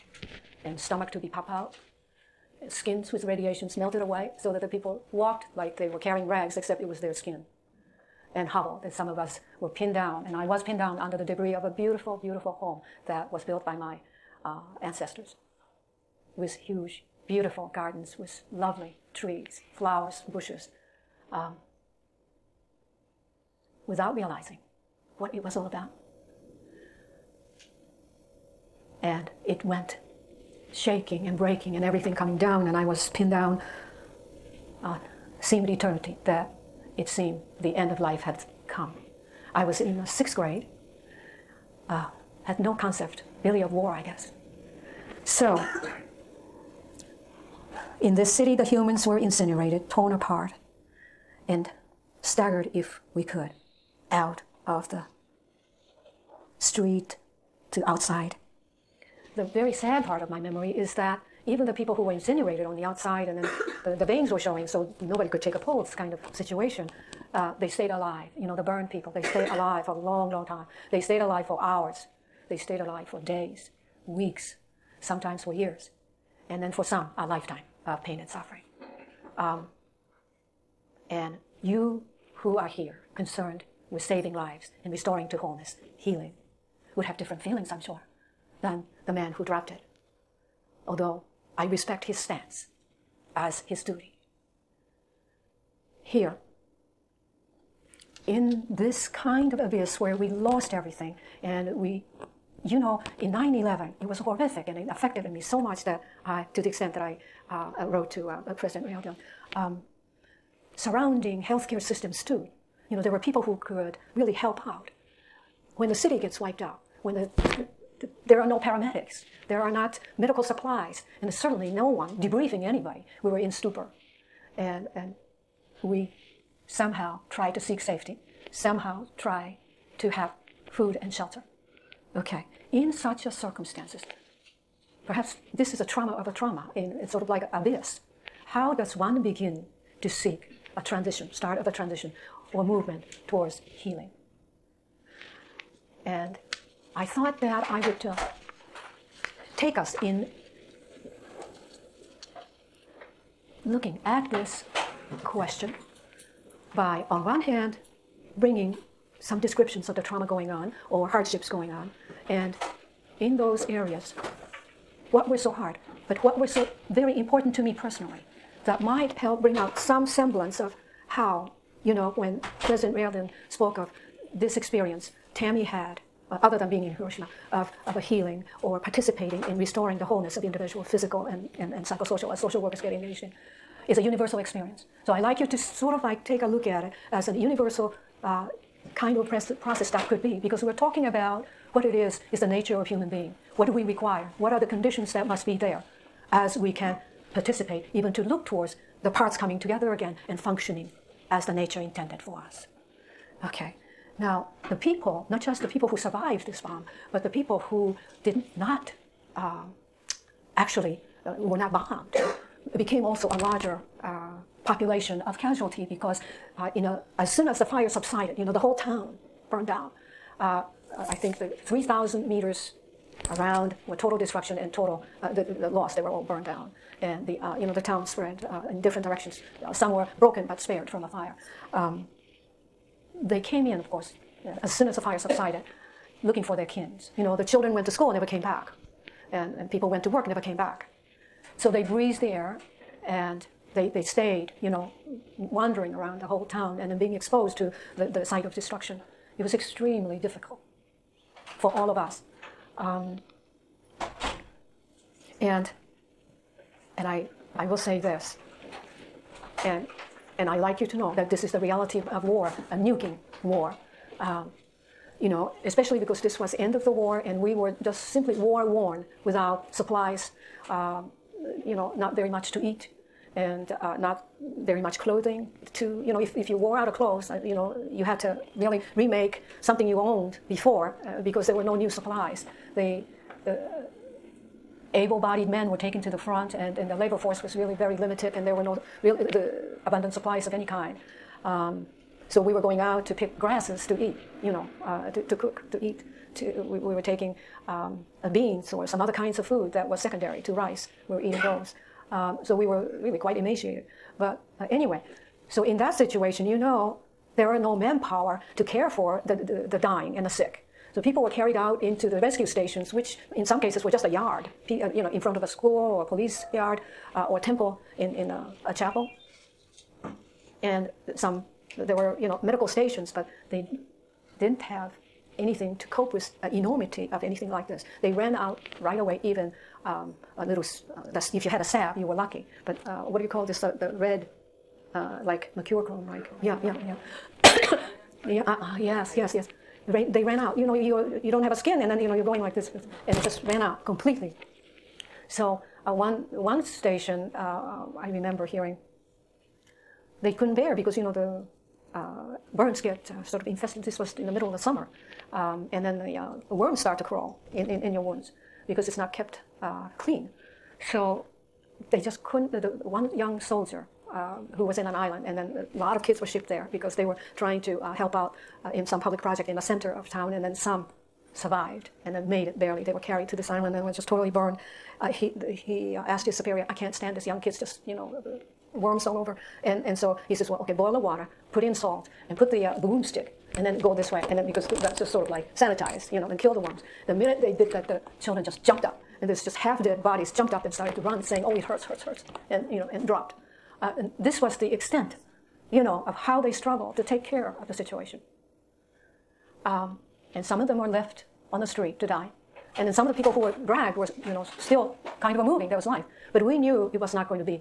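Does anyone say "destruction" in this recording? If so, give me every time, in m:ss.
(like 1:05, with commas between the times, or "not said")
3:44, 4:08.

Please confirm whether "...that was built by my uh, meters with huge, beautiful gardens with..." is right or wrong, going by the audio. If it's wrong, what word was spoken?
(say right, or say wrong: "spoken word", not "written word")
wrong: "ancestors", not "meters".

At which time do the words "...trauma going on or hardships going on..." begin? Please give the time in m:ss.
2:40.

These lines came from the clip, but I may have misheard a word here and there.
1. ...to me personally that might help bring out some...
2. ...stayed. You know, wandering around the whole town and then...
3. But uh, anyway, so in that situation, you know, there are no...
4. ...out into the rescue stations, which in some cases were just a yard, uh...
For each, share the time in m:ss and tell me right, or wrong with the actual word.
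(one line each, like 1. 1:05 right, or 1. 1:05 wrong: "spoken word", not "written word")
1. 2:47 right
2. 4:04 right
3. 5:04 right
4. 5:11 right.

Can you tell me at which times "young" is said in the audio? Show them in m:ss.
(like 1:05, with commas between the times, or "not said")
6:03, 6:17.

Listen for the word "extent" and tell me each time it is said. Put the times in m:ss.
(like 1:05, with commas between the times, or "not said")
1:46, 6:34.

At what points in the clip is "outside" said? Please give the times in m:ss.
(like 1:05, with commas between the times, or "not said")
0:57, 1:02.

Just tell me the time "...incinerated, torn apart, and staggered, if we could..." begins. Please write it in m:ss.
0:49.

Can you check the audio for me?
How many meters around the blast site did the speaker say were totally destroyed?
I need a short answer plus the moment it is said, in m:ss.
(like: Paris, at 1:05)
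3,000 meters, at 3:41.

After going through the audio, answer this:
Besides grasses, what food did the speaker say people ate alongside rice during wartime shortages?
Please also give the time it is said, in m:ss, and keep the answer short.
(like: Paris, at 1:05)
Beans, at 4:58.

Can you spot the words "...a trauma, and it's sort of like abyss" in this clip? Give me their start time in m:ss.
2:16.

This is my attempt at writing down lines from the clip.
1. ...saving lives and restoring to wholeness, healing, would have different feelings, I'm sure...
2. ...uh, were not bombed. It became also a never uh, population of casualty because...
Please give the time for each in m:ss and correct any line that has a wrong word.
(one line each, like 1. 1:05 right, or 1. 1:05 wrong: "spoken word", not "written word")
1. 1:24 right
2. 3:31 wrong: "larger", not "never".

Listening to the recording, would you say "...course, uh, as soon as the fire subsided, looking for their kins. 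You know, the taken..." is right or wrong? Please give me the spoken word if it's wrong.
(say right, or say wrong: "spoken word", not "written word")
wrong: "children", not "taken".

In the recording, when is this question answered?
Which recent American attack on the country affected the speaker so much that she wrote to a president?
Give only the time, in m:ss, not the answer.
1:43.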